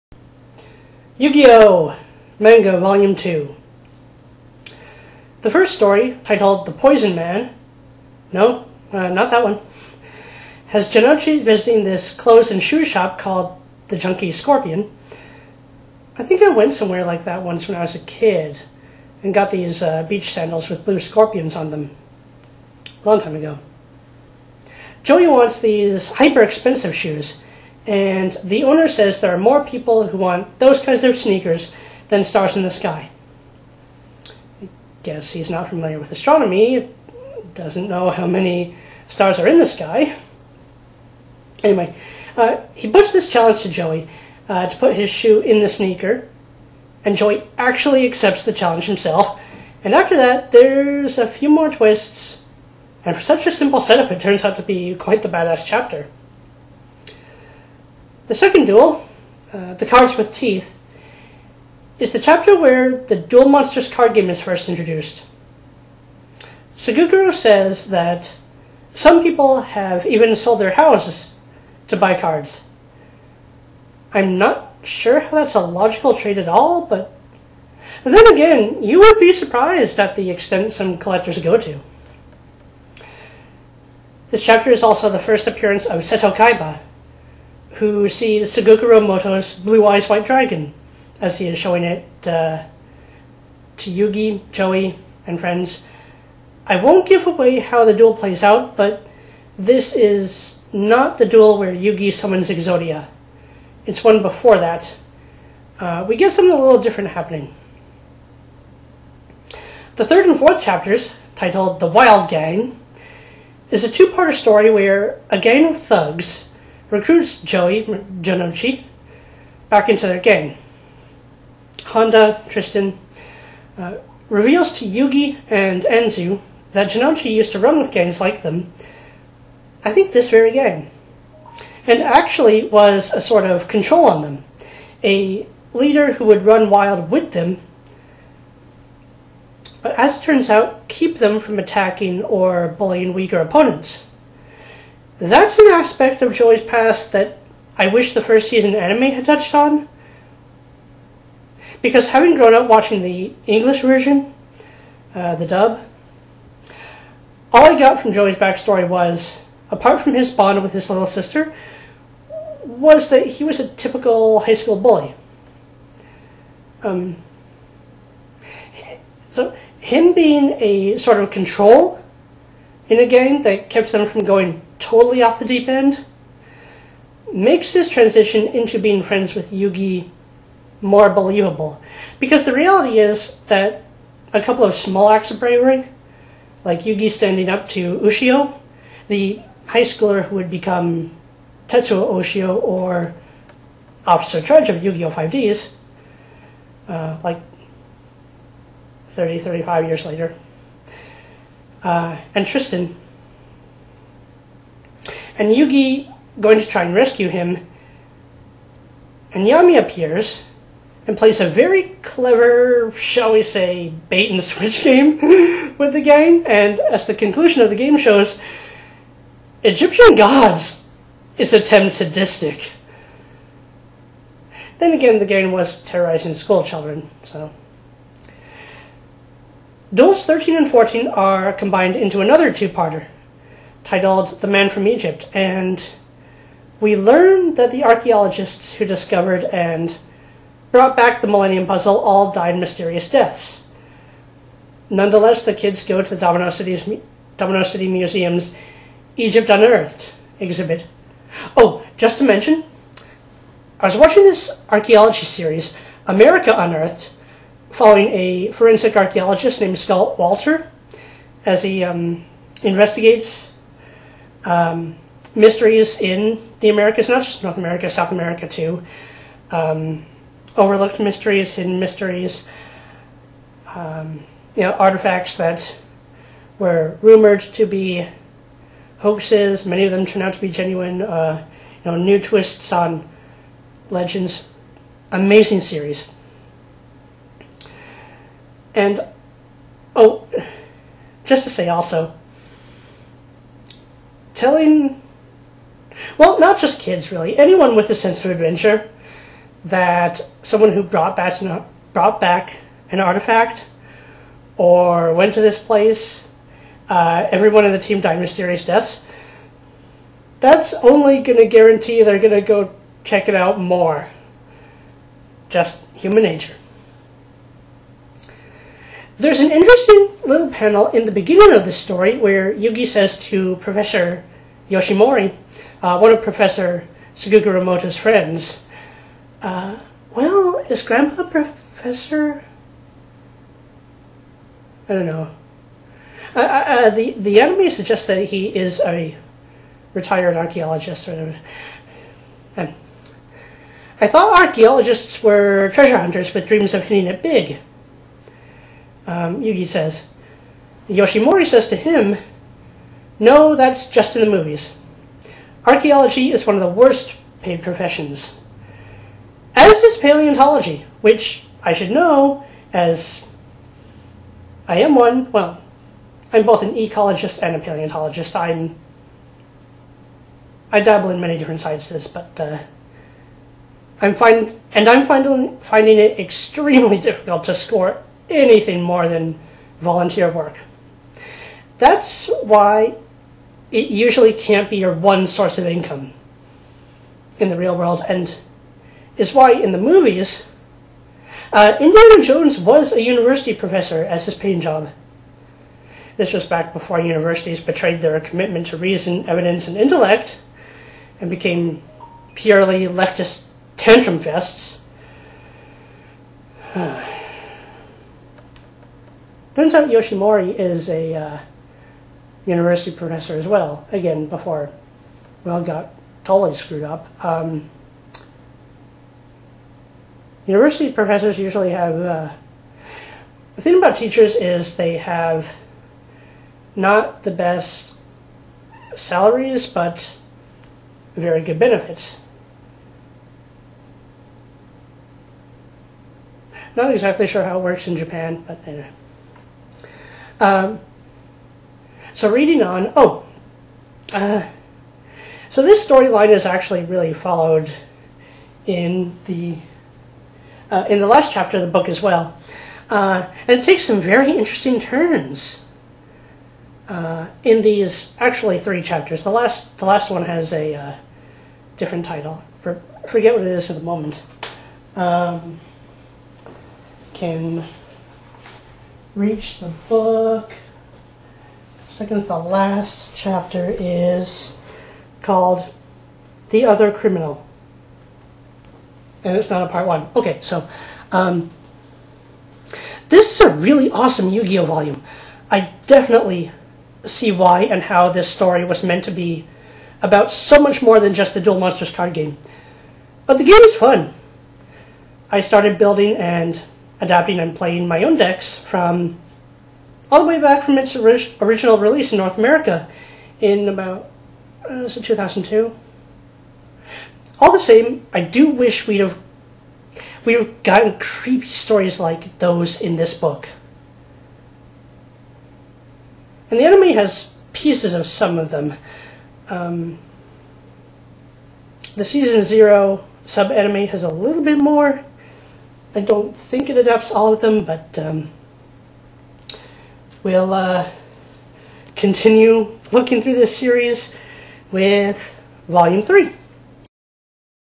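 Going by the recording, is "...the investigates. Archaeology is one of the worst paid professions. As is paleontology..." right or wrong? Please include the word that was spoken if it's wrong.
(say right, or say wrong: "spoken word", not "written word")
wrong: "movies", not "investigates".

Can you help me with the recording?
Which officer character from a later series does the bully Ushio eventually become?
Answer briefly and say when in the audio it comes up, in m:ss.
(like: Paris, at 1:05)
Officer Trudge, at 3:14.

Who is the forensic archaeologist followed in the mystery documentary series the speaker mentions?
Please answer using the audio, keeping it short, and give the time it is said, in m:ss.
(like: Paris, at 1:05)
Scott Wolter, at 4:19.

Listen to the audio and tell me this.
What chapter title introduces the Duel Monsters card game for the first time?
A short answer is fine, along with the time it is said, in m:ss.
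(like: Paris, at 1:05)
The Cards with Teeth, at 0:59.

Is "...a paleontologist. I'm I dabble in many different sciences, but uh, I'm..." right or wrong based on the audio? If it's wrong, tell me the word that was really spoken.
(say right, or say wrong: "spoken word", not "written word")
right.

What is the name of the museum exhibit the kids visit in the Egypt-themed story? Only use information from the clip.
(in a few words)
Egypt Unearthed.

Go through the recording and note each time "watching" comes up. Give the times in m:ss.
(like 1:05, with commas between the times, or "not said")
2:32, 4:13.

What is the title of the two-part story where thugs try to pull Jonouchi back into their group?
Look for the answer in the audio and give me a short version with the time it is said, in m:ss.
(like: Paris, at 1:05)
The Wild Gang, at 1:51.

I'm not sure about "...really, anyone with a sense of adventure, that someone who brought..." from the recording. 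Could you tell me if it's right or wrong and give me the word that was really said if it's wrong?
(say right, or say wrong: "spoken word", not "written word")
right.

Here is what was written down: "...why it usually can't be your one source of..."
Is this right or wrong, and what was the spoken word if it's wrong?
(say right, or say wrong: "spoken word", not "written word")
right.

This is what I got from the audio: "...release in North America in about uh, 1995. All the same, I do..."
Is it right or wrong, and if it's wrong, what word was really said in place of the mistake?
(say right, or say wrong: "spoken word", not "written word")
wrong: "2002", not "1995".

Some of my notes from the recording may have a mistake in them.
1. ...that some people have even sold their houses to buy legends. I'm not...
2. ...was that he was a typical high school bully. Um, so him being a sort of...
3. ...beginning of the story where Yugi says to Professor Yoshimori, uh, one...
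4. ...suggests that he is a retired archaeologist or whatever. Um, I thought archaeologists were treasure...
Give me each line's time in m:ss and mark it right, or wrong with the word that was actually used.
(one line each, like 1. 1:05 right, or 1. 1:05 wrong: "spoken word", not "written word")
1. 1:07 wrong: "cards", not "legends"
2. 2:42 right
3. 5:21 right
4. 5:37 right.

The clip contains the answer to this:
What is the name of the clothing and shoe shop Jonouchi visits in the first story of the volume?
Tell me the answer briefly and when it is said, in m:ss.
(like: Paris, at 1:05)
The Junkie Scorpion, at 0:13.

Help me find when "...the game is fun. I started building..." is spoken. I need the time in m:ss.
8:13.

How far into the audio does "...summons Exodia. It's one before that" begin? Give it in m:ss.
1:42.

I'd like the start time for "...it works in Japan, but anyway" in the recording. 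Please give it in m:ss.
7:17.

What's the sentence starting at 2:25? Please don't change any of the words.
That's an aspect of Joey's past that I wish the first season anime had touched on.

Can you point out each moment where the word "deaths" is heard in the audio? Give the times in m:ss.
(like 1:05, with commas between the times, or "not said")
4:03, 5:08.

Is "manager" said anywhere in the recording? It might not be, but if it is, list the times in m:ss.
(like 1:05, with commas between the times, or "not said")
not said.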